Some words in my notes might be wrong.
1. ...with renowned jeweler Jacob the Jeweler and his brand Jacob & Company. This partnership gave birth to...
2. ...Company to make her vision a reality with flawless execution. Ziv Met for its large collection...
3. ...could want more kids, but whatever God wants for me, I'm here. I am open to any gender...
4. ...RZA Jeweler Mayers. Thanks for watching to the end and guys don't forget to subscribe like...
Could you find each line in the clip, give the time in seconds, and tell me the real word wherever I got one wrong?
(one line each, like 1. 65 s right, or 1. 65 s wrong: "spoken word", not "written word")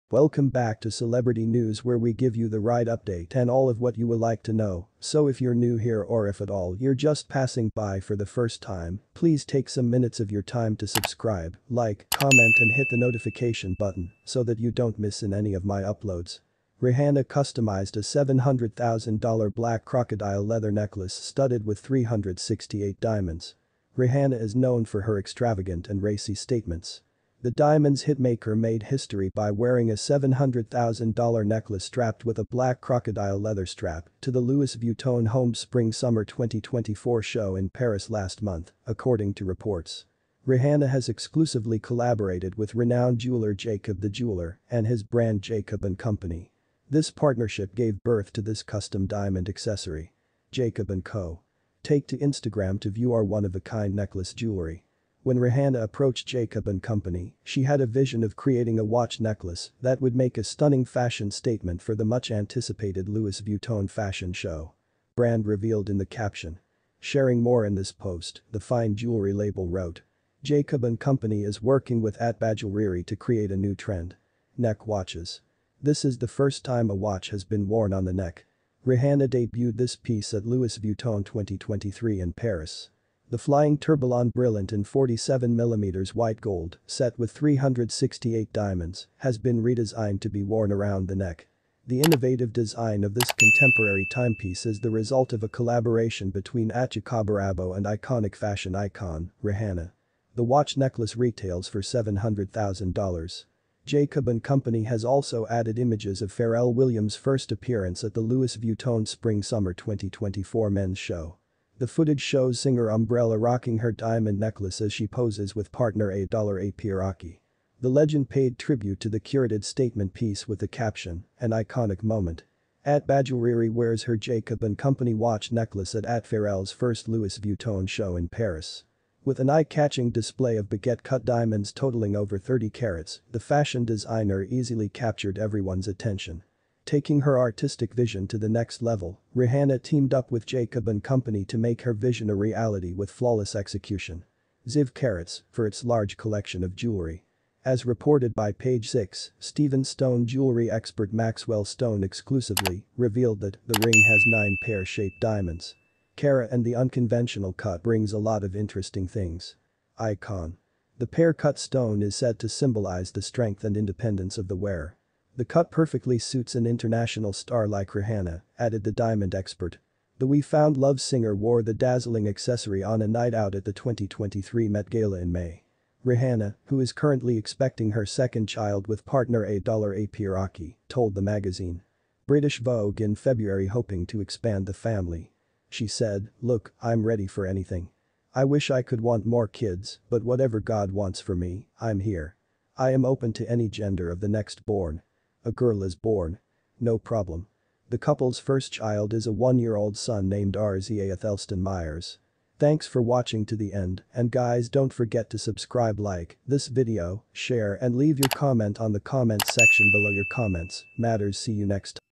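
1. 42 s right
2. 141 s wrong: "Carrots", not "Met"
3. 188 s right
4. 200 s wrong: "Athelston", not "Jeweler".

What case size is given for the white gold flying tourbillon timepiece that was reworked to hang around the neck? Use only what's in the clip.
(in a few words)
47mm.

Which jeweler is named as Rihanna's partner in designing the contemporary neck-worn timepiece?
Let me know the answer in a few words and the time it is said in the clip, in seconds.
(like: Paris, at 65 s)
Jacob Arabo, at 96 s.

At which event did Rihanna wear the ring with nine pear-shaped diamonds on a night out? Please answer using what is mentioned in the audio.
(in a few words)
2023 Met Gala.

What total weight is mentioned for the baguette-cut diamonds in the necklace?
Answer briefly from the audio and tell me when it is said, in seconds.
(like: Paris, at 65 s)
over 30 carats, at 132 s.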